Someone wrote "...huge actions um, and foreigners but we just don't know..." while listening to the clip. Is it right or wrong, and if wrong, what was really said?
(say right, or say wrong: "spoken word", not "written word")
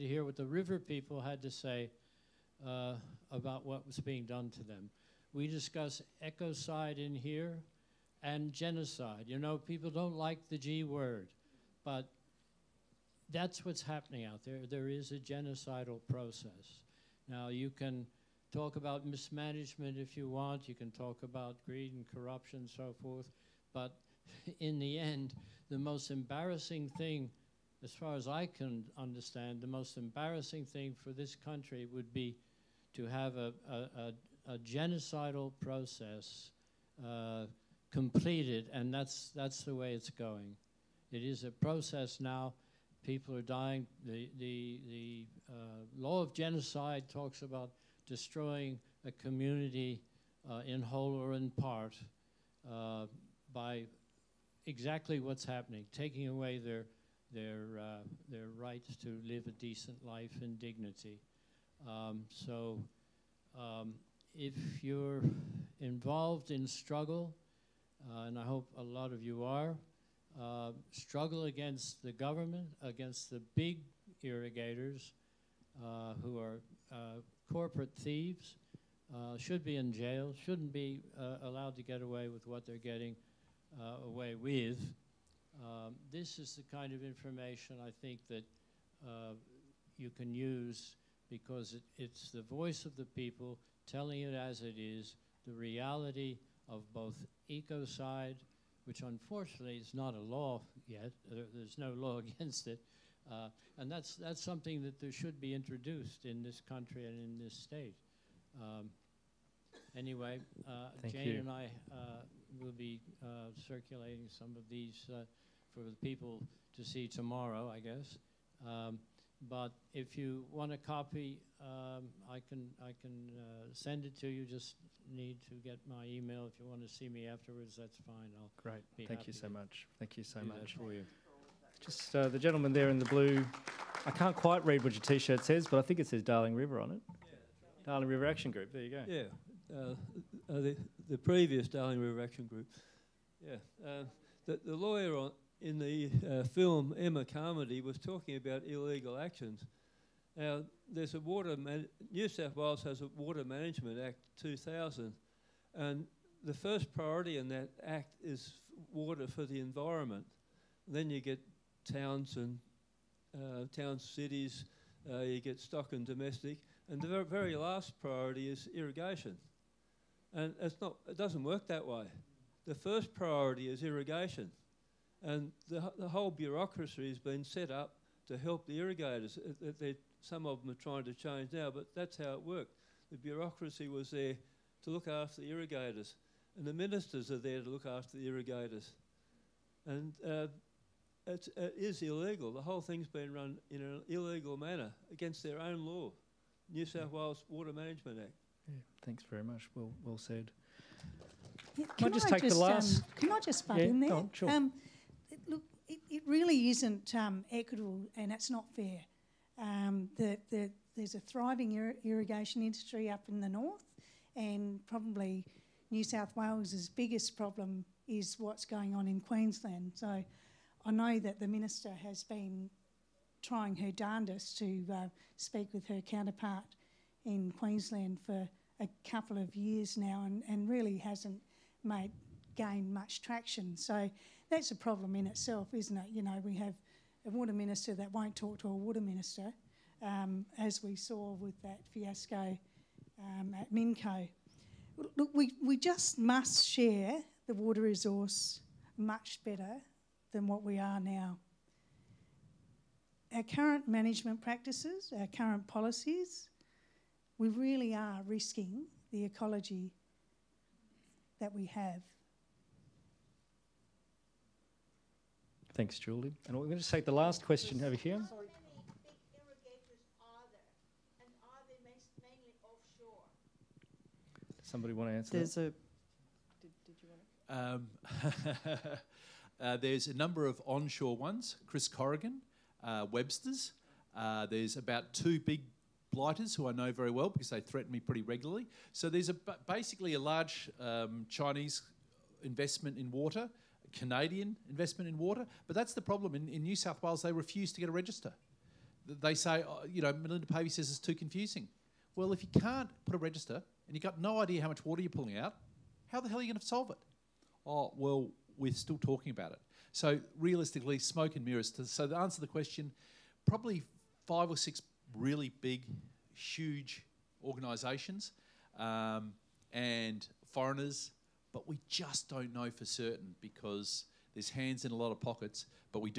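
wrong: "organisations", not "actions".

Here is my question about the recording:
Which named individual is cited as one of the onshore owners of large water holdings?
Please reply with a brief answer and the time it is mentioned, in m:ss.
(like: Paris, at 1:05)
Chris Corrigan, at 4:41.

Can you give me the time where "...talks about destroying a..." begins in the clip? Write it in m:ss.
0:47.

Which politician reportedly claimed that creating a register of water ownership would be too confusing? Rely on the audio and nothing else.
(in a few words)
Melinda Pavey.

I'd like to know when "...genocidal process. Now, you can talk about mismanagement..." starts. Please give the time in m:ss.
0:15.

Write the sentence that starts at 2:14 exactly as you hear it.
I can't quite read what your T-shirt says, but I think it says Darling River on it.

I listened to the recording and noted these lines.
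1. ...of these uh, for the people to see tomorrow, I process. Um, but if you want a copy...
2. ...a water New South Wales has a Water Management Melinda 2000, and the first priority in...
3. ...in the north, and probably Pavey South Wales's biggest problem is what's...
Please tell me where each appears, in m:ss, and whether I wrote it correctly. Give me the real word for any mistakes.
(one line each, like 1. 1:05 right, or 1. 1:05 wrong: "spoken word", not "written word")
1. 1:54 wrong: "guess", not "process"
2. 2:31 wrong: "Act", not "Melinda"
3. 3:33 wrong: "New", not "Pavey".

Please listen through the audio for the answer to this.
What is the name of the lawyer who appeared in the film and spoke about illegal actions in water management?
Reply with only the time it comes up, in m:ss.
2:26.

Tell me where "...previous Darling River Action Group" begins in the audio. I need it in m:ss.
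2:21.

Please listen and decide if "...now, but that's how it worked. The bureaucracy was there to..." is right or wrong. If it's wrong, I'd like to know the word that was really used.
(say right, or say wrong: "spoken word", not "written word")
right.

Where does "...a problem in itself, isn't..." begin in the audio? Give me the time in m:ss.
3:54.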